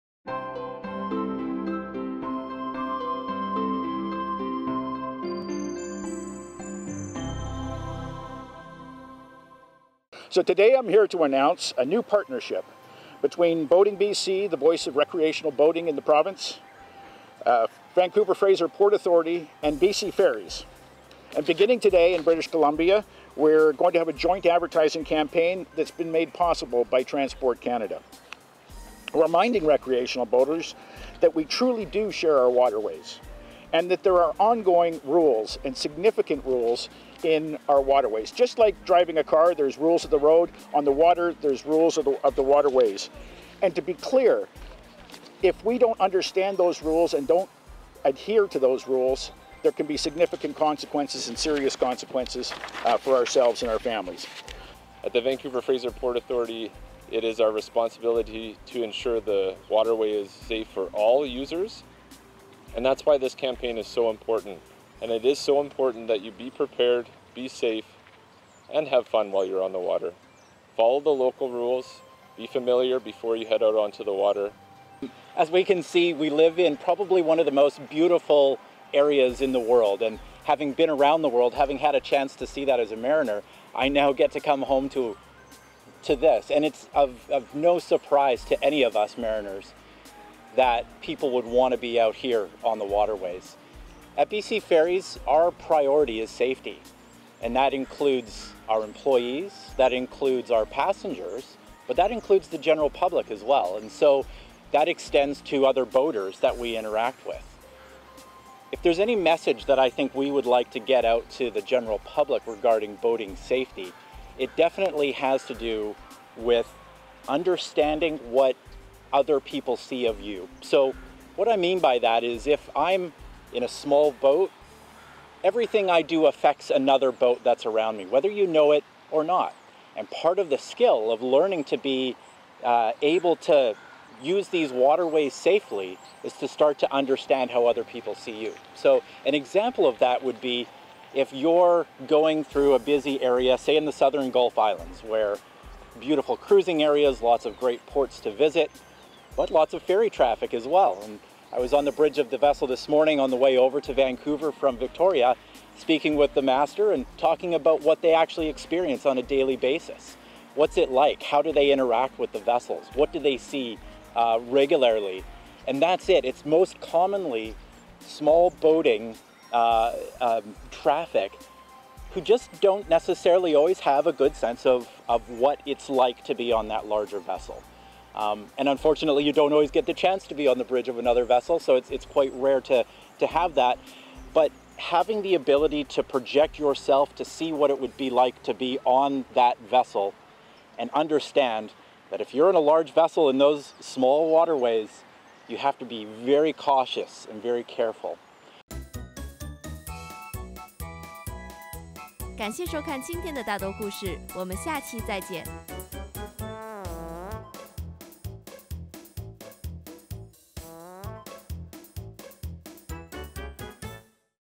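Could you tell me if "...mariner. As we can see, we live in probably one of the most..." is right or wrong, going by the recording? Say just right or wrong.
wrong.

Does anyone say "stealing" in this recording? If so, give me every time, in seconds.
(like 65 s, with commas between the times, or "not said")
not said.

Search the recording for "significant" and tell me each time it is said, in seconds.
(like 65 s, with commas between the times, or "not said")
35 s, 49 s.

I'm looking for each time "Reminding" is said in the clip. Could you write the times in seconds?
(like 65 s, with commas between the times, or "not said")
29 s.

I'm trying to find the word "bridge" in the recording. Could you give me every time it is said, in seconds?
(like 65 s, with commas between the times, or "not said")
151 s, 180 s.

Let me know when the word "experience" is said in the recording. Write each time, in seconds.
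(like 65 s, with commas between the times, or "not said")
158 s.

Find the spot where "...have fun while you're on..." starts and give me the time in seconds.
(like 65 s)
68 s.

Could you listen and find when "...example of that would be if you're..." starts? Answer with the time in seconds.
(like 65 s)
139 s.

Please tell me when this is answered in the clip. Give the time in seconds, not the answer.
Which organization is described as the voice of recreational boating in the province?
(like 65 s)
13 s.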